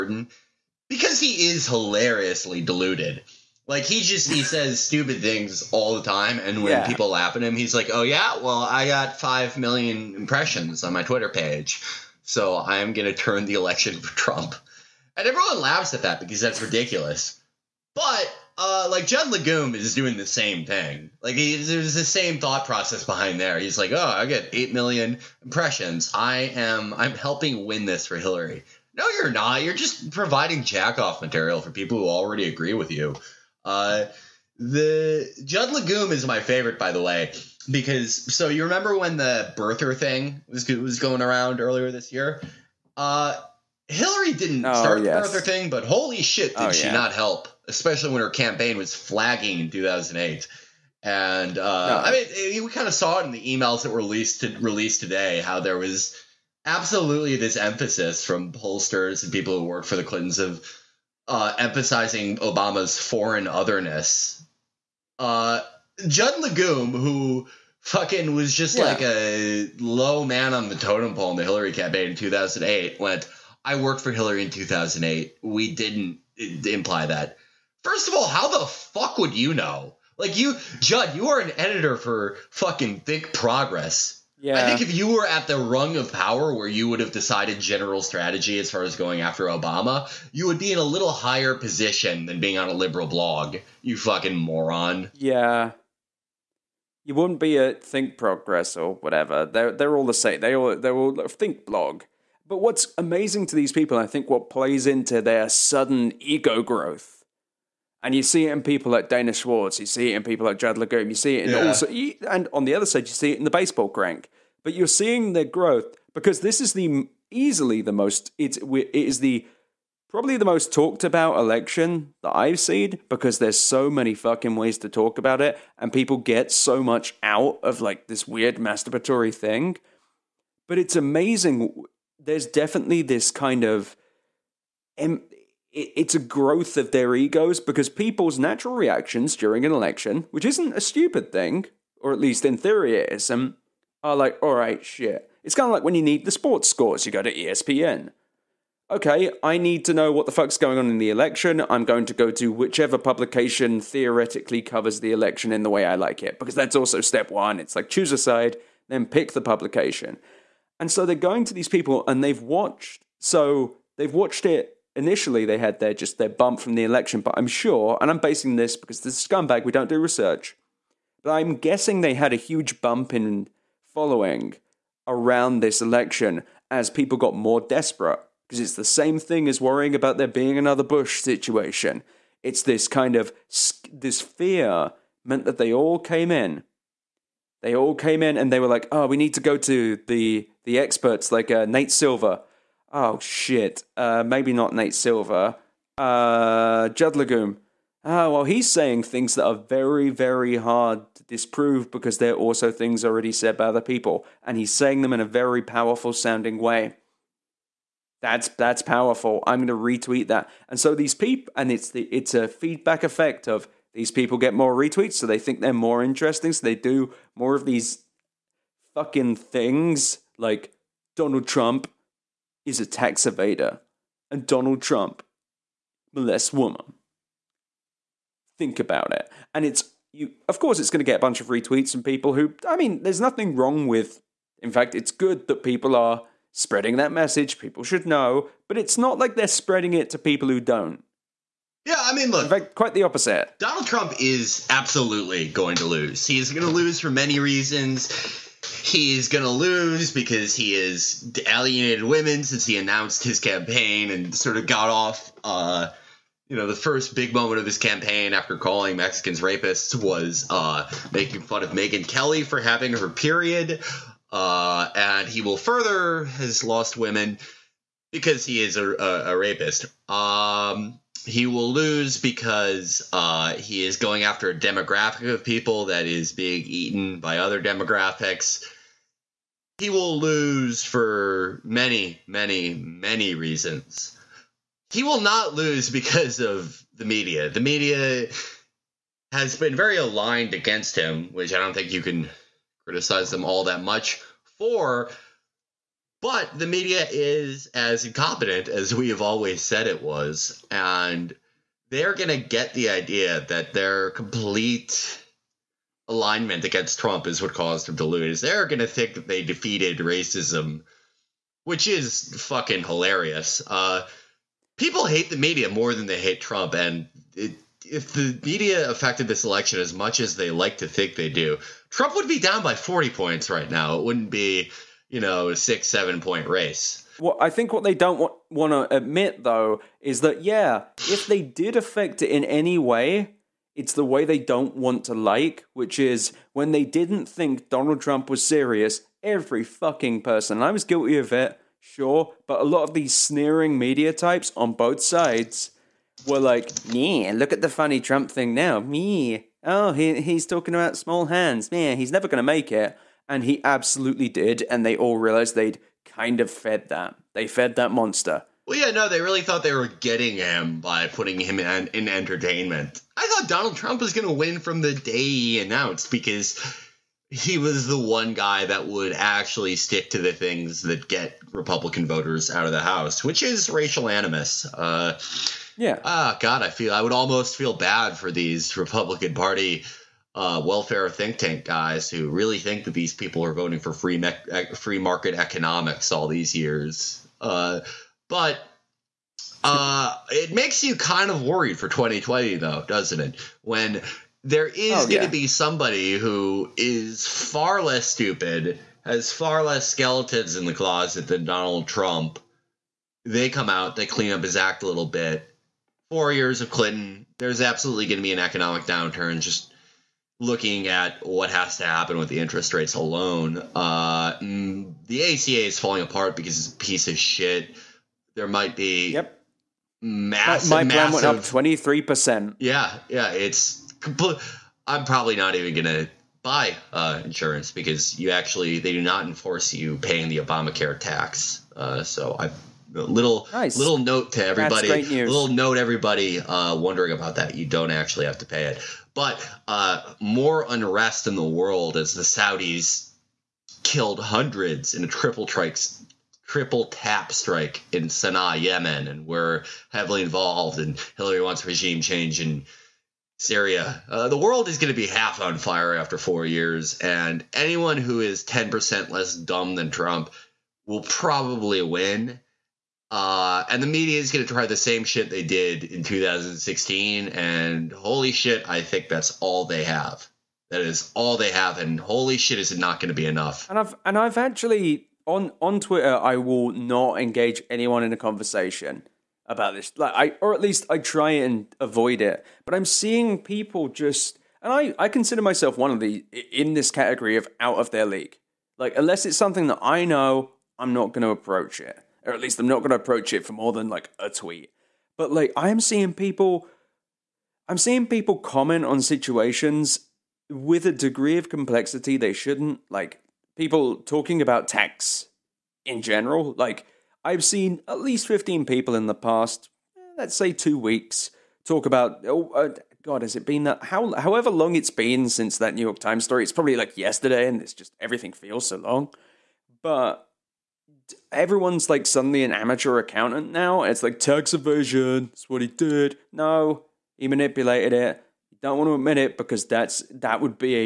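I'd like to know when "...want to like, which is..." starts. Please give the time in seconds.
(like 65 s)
334 s.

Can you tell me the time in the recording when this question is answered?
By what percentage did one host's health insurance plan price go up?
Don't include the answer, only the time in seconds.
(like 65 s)
421 s.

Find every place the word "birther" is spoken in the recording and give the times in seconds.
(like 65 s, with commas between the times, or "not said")
39 s, 45 s.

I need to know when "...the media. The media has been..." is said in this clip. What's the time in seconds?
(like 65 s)
286 s.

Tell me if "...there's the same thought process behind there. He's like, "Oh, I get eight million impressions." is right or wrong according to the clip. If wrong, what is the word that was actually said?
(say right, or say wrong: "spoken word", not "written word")
right.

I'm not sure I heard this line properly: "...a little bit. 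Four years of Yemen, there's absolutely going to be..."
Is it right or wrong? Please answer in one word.
wrong.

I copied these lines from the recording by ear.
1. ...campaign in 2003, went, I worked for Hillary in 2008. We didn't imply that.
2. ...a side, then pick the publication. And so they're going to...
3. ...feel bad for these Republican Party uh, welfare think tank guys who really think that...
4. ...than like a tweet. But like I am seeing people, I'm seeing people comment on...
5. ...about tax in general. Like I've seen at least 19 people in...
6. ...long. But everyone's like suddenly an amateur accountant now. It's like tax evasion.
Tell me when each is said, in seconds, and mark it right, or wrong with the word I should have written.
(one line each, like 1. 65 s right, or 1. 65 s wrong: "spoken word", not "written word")
1. 71 s wrong: "2008", not "2003"
2. 158 s right
3. 377 s right
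4. 493 s right
5. 504 s wrong: "15", not "19"
6. 518 s right.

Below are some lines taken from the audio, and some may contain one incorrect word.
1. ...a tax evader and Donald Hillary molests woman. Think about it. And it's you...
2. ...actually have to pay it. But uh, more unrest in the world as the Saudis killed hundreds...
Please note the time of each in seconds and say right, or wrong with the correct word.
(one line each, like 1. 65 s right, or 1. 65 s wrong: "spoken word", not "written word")
1. 222 s wrong: "Trump", not "Hillary"
2. 437 s right.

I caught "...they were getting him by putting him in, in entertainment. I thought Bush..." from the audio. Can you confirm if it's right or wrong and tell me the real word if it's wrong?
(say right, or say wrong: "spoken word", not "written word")
wrong: "Donald", not "Bush".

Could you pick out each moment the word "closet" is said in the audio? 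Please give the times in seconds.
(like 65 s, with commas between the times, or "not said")
400 s.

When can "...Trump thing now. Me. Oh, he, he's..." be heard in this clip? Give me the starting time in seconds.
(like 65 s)
347 s.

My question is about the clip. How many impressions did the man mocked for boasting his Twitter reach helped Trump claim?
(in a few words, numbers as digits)
5 million.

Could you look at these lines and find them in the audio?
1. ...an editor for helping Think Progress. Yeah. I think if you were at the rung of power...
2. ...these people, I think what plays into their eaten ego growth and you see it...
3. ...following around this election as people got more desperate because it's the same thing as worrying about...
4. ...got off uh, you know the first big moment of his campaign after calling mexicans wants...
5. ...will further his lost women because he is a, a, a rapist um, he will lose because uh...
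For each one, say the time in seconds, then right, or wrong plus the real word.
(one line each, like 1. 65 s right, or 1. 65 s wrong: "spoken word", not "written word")
1. 81 s wrong: "fucking", not "helping"
2. 103 s wrong: "sudden", not "eaten"
3. 173 s right
4. 254 s wrong: "rapists", not "wants"
5. 265 s right.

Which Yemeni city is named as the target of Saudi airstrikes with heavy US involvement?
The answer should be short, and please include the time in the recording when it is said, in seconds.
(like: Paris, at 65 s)
Sana'a, at 448 s.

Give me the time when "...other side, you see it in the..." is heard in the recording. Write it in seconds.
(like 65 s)
112 s.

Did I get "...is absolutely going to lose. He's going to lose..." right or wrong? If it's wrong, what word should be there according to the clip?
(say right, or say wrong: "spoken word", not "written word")
right.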